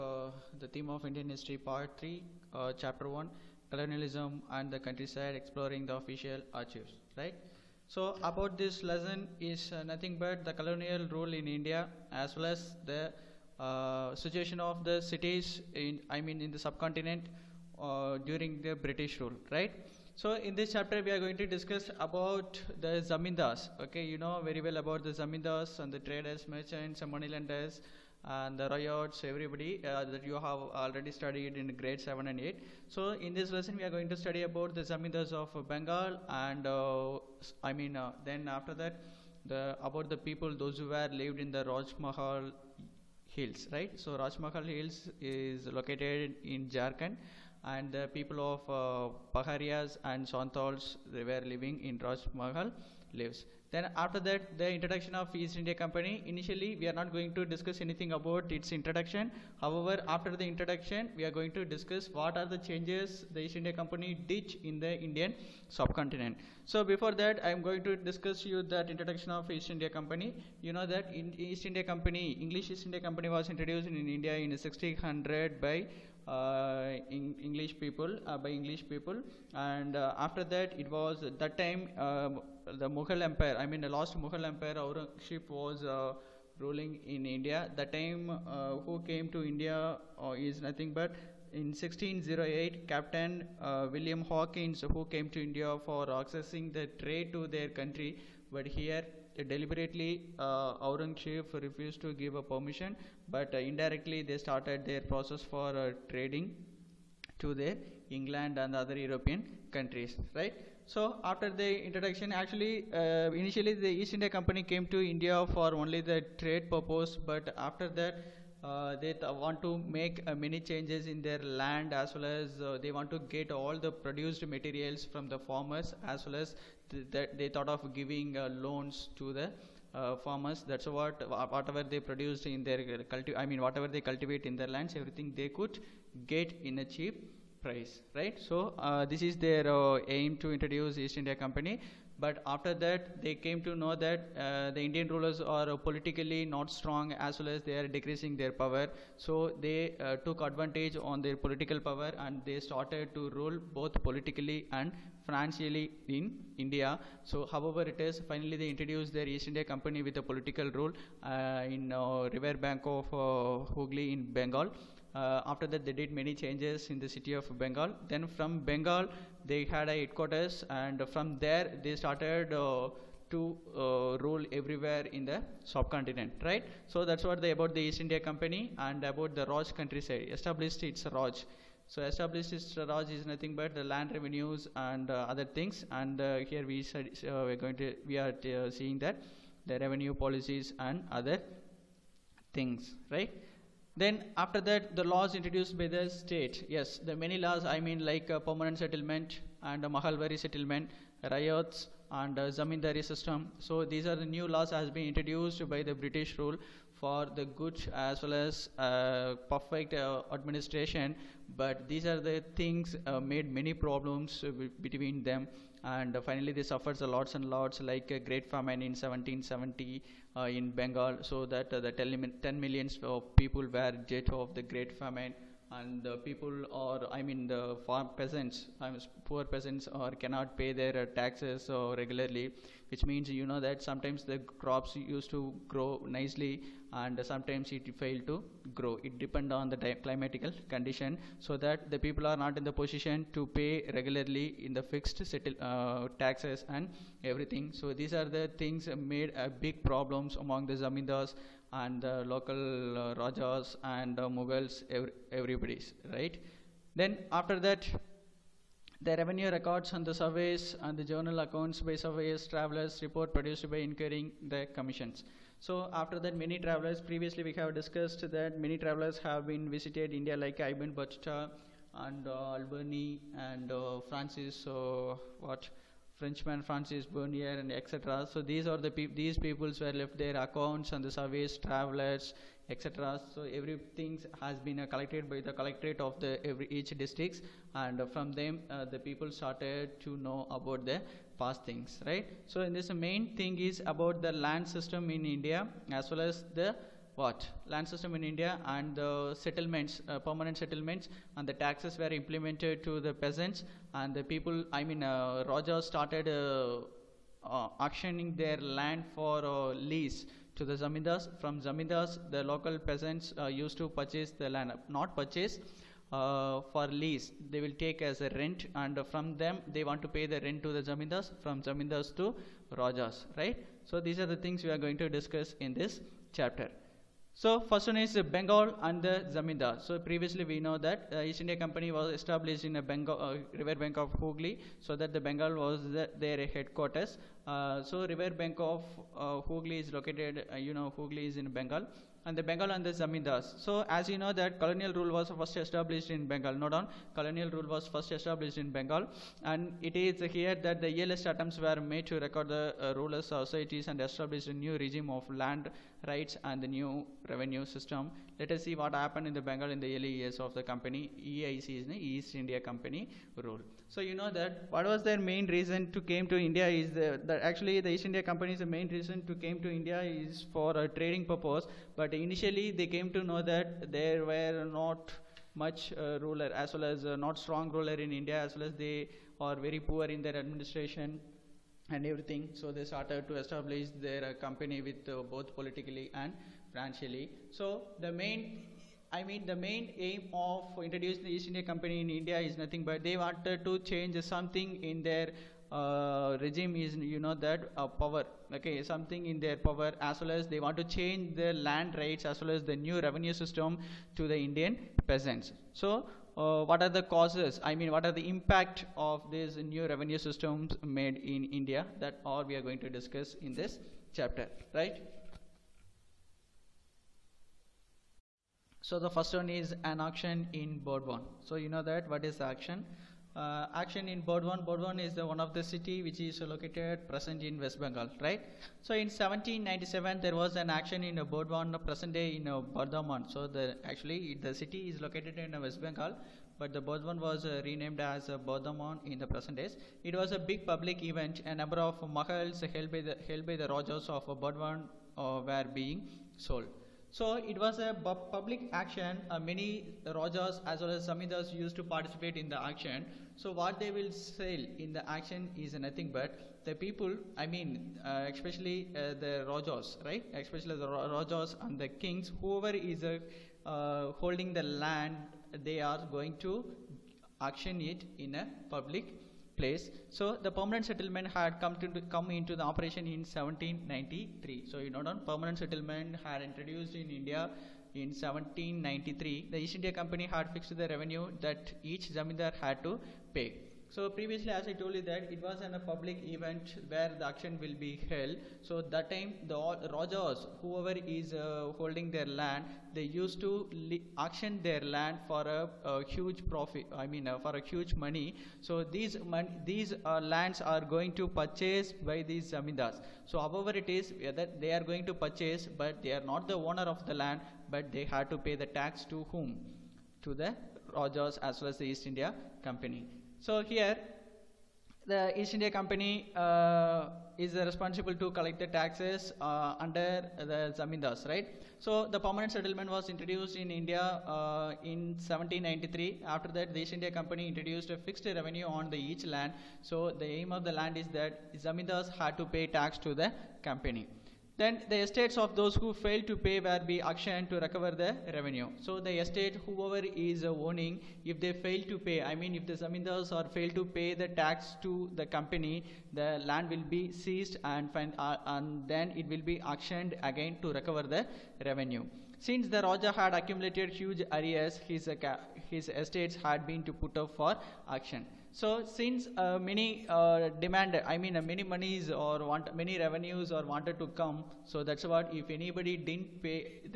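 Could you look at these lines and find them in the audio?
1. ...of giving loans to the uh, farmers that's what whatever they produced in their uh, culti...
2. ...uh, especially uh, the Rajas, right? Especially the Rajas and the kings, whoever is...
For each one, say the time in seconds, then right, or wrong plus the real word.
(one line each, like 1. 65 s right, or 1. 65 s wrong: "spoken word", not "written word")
1. 127 s right
2. 458 s right.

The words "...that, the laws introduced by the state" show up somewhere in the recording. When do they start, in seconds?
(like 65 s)
194 s.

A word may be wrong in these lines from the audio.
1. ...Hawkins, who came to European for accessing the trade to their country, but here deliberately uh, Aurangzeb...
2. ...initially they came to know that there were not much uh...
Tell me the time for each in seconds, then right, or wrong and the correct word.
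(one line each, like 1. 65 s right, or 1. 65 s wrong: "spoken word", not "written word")
1. 94 s wrong: "India", not "European"
2. 372 s right.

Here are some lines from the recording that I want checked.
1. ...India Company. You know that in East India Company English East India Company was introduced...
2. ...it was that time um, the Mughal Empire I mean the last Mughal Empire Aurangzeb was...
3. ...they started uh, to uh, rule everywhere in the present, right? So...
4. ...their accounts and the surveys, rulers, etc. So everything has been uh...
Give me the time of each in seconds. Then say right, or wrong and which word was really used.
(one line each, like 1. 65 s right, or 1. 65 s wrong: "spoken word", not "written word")
1. 69 s right
2. 80 s right
3. 171 s wrong: "subcontinent", not "present"
4. 280 s wrong: "travelers", not "rulers".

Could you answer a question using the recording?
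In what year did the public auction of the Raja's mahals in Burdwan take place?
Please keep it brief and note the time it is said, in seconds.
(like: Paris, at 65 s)
1797, at 429 s.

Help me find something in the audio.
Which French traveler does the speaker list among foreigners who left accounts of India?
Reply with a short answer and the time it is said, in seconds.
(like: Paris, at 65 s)
Francis Bernier, at 276 s.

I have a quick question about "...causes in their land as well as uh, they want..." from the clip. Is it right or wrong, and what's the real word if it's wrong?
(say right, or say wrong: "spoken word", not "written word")
wrong: "changes", not "causes".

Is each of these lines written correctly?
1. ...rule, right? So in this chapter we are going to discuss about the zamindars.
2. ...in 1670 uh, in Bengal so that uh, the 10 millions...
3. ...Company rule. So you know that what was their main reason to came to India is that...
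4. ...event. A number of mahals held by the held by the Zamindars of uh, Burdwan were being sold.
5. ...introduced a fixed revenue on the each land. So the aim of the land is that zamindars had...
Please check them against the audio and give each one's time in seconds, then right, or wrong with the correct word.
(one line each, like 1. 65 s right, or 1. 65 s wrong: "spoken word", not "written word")
1. 19 s right
2. 218 s wrong: "1770", not "1670"
3. 362 s right
4. 441 s wrong: "Rajas", not "Zamindars"
5. 527 s right.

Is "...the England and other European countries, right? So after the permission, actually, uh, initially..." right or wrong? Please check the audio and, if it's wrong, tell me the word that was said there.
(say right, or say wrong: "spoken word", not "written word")
wrong: "introduction", not "permission".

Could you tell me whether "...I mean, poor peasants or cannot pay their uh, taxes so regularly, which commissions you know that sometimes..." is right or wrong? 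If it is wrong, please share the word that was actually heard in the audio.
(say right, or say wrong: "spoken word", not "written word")
wrong: "means", not "commissions".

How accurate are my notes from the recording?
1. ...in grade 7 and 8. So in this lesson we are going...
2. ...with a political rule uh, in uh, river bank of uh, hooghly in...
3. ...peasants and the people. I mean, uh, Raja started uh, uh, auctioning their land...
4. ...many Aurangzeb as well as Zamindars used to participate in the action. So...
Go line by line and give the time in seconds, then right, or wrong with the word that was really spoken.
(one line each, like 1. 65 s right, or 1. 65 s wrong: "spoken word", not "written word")
1. 31 s right
2. 160 s right
3. 303 s right
4. 449 s wrong: "Rajas", not "Aurangzeb".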